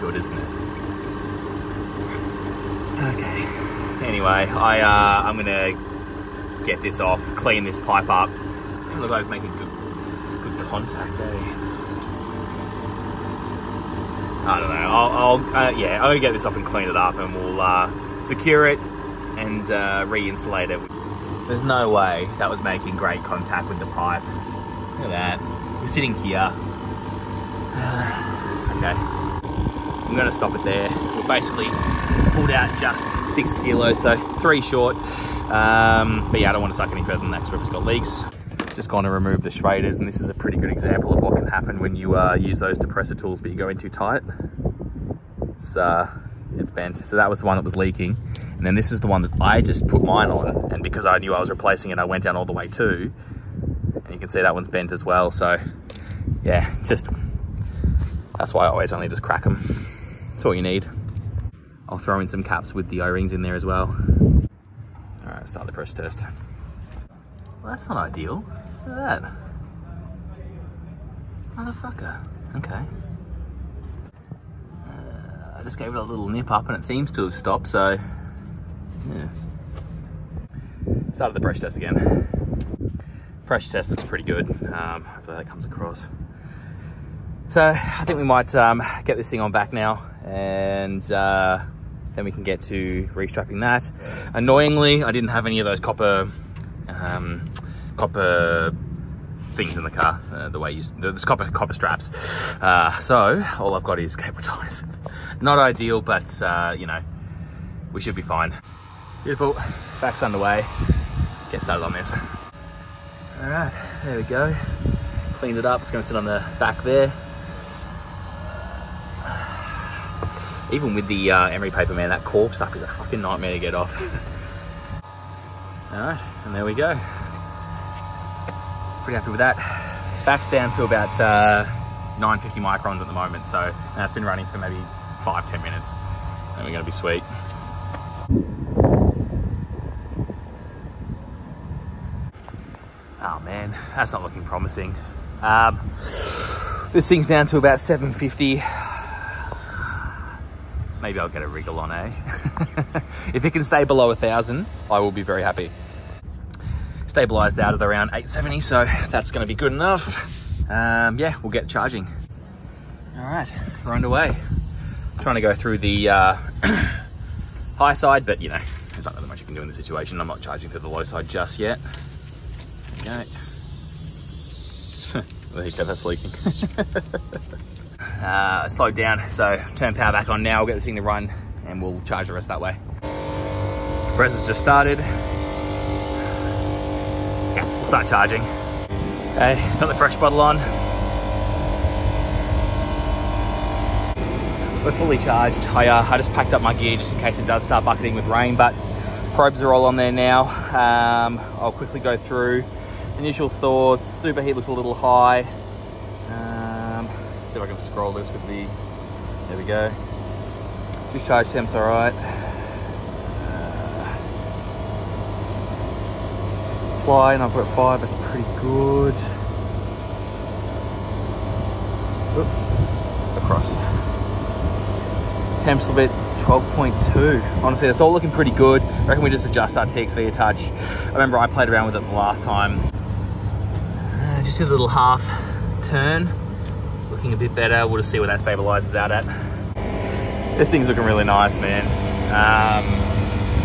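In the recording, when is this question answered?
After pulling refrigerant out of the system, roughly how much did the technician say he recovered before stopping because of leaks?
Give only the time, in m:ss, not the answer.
0:33.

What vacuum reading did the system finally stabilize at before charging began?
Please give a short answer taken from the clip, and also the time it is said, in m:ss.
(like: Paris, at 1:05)
870 microns, at 2:38.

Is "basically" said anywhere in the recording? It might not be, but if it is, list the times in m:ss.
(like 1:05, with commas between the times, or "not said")
0:31.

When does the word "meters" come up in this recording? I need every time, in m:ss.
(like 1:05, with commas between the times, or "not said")
not said.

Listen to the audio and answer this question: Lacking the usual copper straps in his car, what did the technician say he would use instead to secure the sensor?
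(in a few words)
Cable ties.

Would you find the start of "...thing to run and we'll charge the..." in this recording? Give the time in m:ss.
3:00.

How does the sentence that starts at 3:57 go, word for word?
We'll just see where that stabilizes out at.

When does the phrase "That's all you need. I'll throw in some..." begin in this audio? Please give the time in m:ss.
1:00.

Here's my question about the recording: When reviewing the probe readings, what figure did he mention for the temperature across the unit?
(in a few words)
12.2.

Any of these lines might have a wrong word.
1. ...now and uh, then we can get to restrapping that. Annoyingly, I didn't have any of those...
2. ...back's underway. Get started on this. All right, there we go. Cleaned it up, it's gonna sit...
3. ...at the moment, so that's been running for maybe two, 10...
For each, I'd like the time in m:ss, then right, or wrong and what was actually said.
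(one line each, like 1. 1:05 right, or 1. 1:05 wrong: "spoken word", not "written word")
1. 1:29 right
2. 1:50 right
3. 2:13 wrong: "five", not "two".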